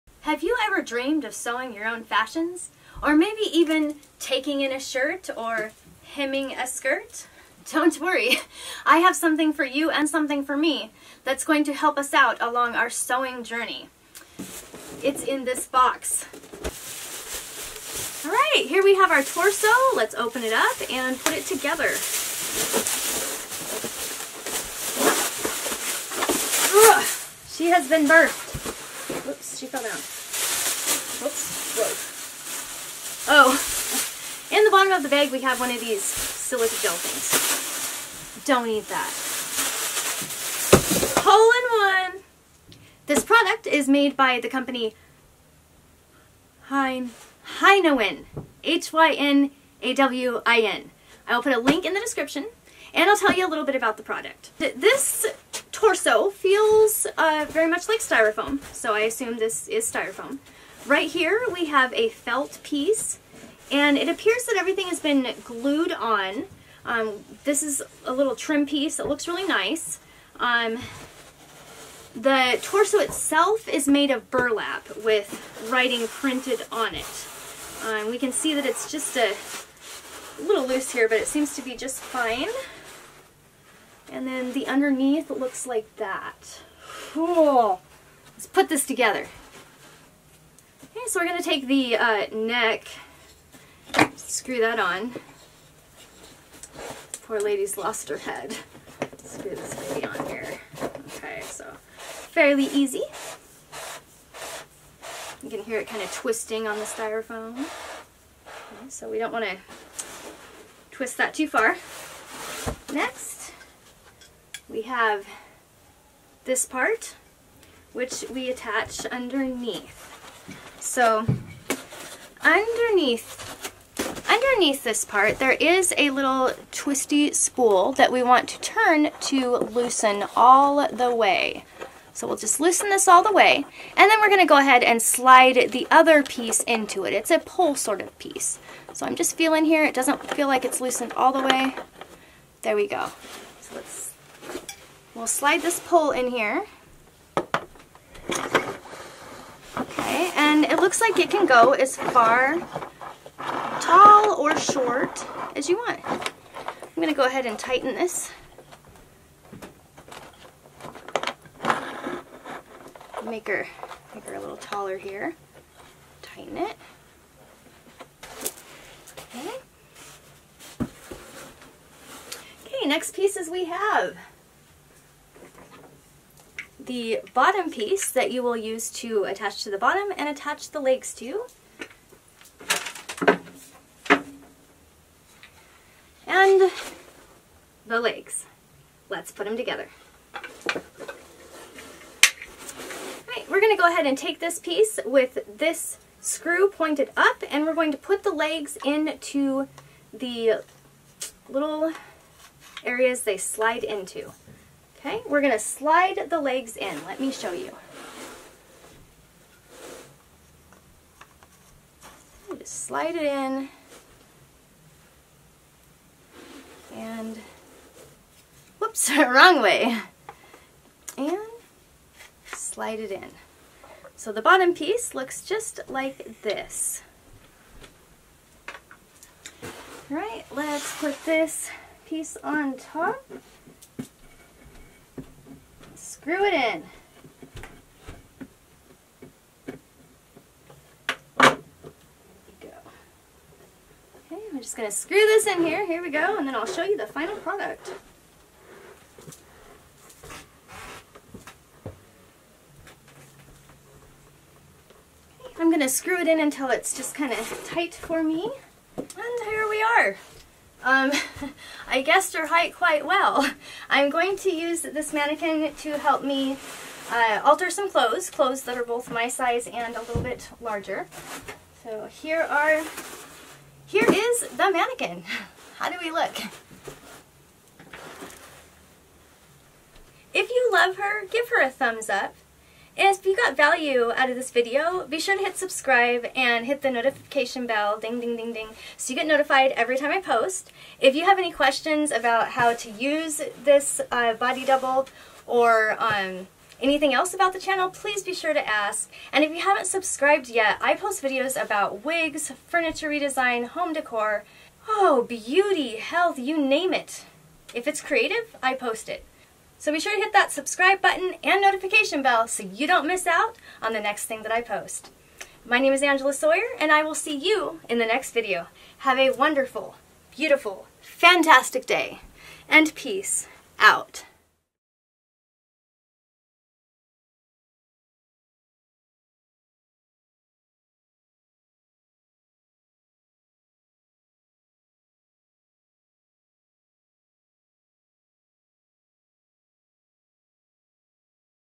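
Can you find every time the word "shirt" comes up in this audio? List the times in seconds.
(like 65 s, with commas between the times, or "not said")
4 s.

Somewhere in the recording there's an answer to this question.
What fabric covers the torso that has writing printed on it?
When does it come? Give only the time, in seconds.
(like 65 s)
74 s.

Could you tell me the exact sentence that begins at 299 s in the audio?
And if you haven't subscribed yet, I post videos about wigs, furniture redesign, home decor, oh, beauty, health, you name it.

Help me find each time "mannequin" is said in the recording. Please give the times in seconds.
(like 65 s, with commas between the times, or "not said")
265 s, 274 s.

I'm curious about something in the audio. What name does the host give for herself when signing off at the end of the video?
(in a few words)
Angela Sawyer.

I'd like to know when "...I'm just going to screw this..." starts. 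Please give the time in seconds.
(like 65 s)
244 s.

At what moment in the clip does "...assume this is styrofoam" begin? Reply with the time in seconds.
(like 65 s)
59 s.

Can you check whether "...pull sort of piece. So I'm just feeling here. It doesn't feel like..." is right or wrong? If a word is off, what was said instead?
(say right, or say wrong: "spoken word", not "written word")
right.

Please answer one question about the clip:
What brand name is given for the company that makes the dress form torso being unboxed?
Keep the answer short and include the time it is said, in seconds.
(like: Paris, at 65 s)
Hein Hynawin, at 46 s.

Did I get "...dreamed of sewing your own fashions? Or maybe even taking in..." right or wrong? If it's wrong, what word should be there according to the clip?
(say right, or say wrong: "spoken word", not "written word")
right.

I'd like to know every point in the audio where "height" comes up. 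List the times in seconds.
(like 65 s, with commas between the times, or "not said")
262 s.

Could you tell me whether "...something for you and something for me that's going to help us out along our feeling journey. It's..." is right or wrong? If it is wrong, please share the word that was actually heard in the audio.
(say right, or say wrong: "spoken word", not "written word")
wrong: "sewing", not "feeling".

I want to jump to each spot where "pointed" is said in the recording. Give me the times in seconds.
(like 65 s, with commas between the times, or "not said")
196 s.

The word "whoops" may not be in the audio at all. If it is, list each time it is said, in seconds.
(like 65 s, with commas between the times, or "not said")
29 s, 218 s.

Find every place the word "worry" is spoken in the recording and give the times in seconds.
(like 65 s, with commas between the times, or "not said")
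7 s.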